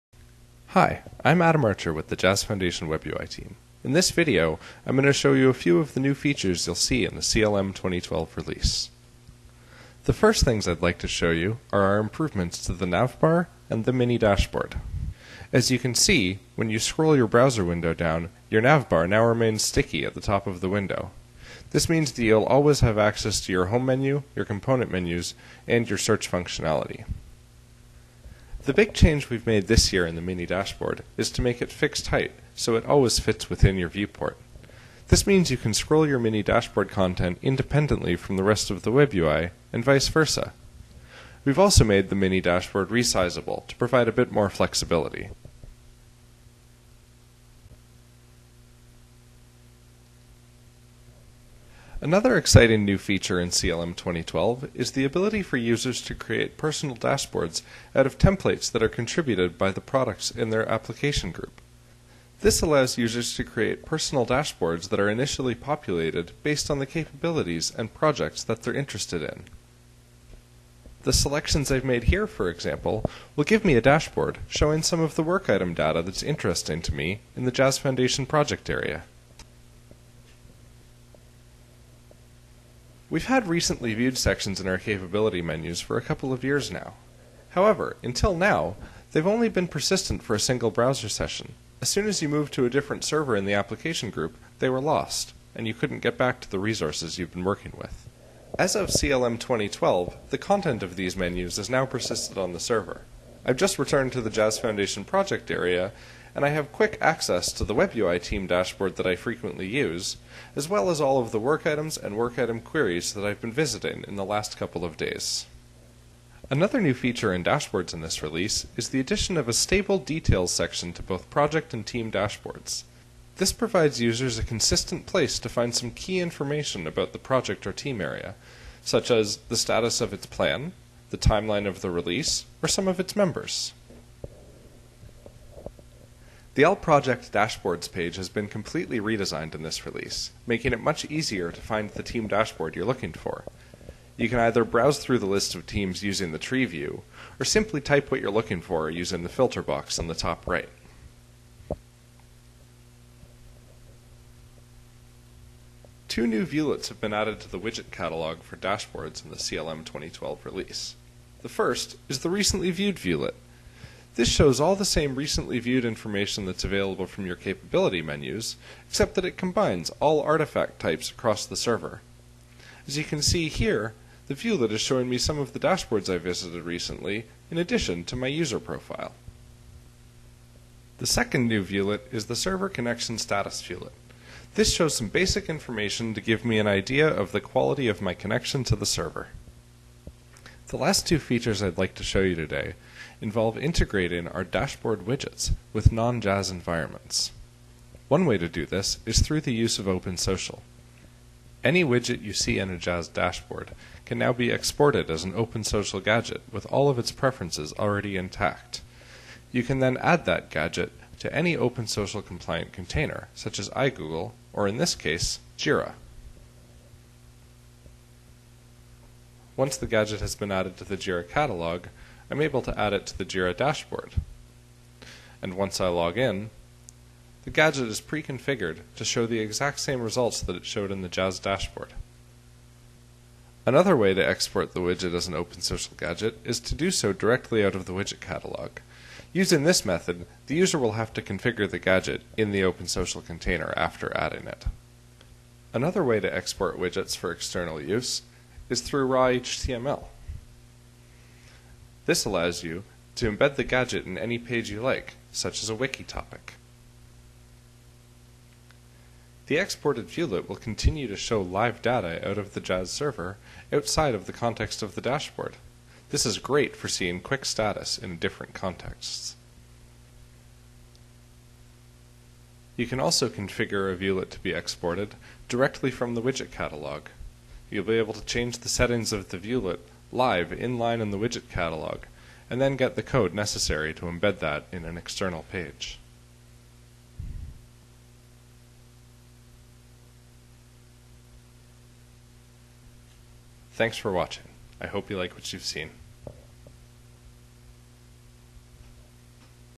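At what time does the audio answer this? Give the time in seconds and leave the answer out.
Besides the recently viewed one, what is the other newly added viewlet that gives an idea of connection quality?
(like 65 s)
182 s.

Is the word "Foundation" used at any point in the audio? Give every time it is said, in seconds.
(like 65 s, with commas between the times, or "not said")
2 s, 77 s, 104 s.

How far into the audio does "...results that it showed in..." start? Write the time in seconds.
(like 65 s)
230 s.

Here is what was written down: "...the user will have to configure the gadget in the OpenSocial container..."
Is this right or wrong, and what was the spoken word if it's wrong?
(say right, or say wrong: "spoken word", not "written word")
right.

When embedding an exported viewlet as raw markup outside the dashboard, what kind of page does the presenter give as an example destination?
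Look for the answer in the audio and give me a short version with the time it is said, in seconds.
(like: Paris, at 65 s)
a wiki topic, at 255 s.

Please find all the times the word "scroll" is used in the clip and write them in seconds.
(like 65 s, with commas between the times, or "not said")
16 s, 35 s.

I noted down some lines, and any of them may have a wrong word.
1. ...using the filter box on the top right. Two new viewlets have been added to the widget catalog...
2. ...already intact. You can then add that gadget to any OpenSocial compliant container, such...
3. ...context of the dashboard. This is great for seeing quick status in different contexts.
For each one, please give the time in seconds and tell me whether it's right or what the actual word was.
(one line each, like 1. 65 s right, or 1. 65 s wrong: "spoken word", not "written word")
1. 148 s right
2. 207 s right
3. 264 s right.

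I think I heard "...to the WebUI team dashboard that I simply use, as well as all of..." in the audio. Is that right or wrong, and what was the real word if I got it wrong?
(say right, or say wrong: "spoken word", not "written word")
wrong: "frequently", not "simply".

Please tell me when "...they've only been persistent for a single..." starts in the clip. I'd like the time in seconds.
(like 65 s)
89 s.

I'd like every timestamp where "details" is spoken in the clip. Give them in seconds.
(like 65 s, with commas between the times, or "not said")
119 s.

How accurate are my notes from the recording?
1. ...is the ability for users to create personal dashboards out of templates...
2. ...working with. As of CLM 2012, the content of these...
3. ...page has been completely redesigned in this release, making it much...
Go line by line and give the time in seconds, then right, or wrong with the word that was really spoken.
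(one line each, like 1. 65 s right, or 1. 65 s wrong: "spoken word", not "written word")
1. 54 s right
2. 97 s right
3. 137 s right.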